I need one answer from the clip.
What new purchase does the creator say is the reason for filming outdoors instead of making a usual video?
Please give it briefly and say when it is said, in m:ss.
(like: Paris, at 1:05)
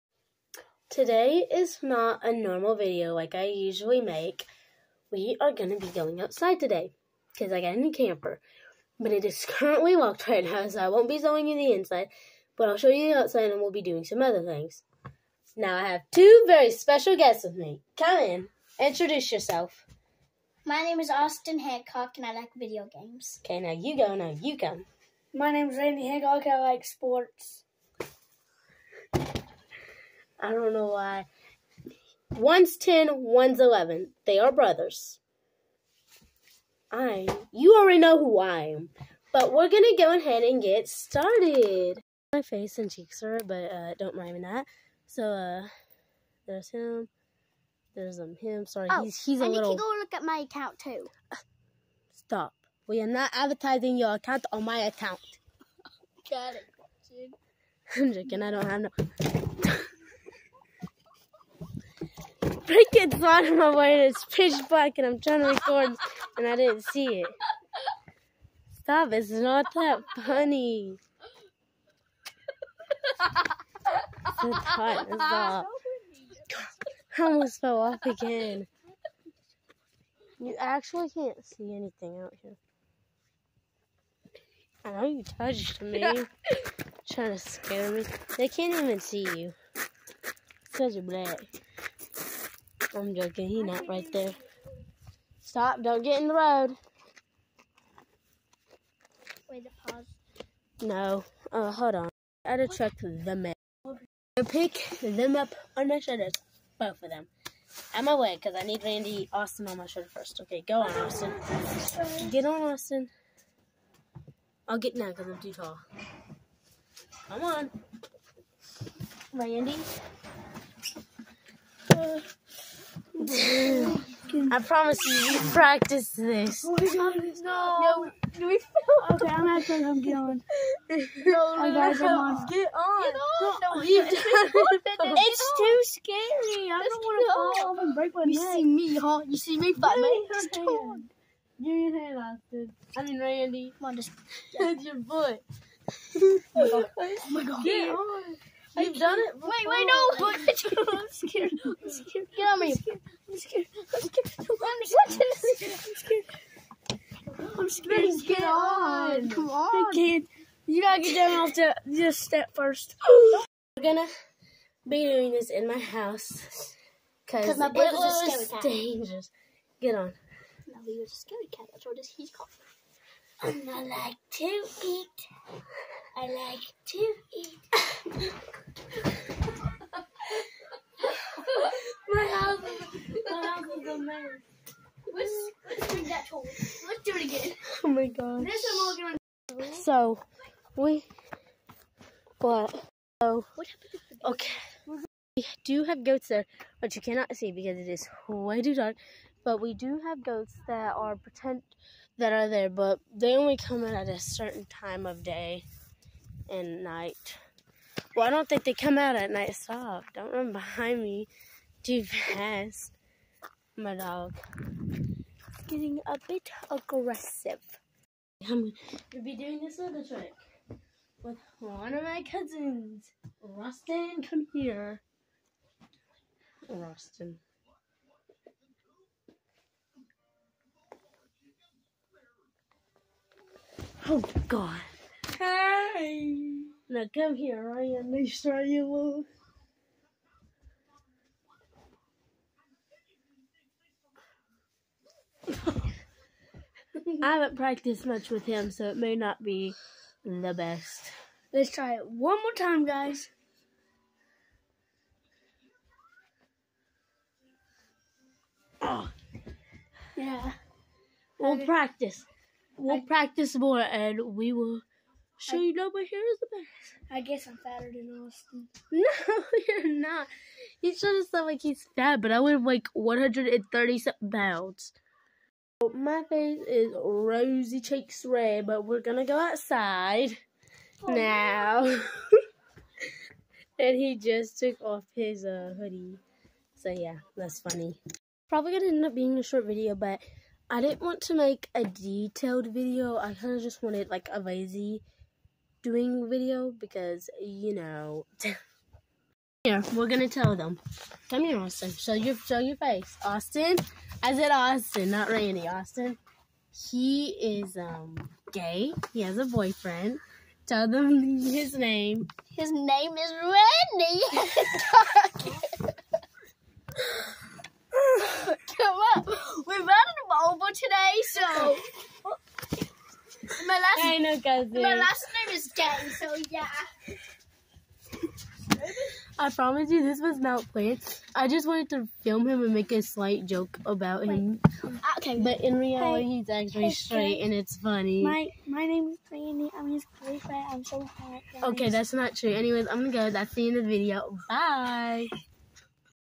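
Camper, at 0:07.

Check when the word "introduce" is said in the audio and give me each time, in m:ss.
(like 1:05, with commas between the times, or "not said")
0:18.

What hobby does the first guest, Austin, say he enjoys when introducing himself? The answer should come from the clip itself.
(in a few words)
Video games.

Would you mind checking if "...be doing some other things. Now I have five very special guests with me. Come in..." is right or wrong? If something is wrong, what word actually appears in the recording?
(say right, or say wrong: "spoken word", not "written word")
wrong: "two", not "five".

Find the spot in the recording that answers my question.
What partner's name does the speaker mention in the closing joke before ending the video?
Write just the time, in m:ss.
5:39.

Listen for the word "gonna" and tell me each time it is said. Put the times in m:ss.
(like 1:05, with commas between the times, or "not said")
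2:43, 3:39, 4:38, 4:48, 5:00, 5:42.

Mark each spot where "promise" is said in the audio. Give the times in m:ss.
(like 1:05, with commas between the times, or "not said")
2:04, 5:29.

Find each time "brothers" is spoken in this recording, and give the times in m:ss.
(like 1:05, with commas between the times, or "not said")
0:34, 2:47.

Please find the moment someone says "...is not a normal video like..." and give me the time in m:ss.
0:01.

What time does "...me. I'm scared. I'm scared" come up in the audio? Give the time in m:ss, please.
2:32.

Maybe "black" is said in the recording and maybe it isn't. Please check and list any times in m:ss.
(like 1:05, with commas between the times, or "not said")
1:04, 1:31.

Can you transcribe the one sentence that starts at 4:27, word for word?
I guess I'm fatter than Austin.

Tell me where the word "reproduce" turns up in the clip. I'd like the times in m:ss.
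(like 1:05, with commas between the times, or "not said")
not said.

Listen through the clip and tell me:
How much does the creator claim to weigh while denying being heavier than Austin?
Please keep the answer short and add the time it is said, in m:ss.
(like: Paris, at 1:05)
130 pounds, at 4:32.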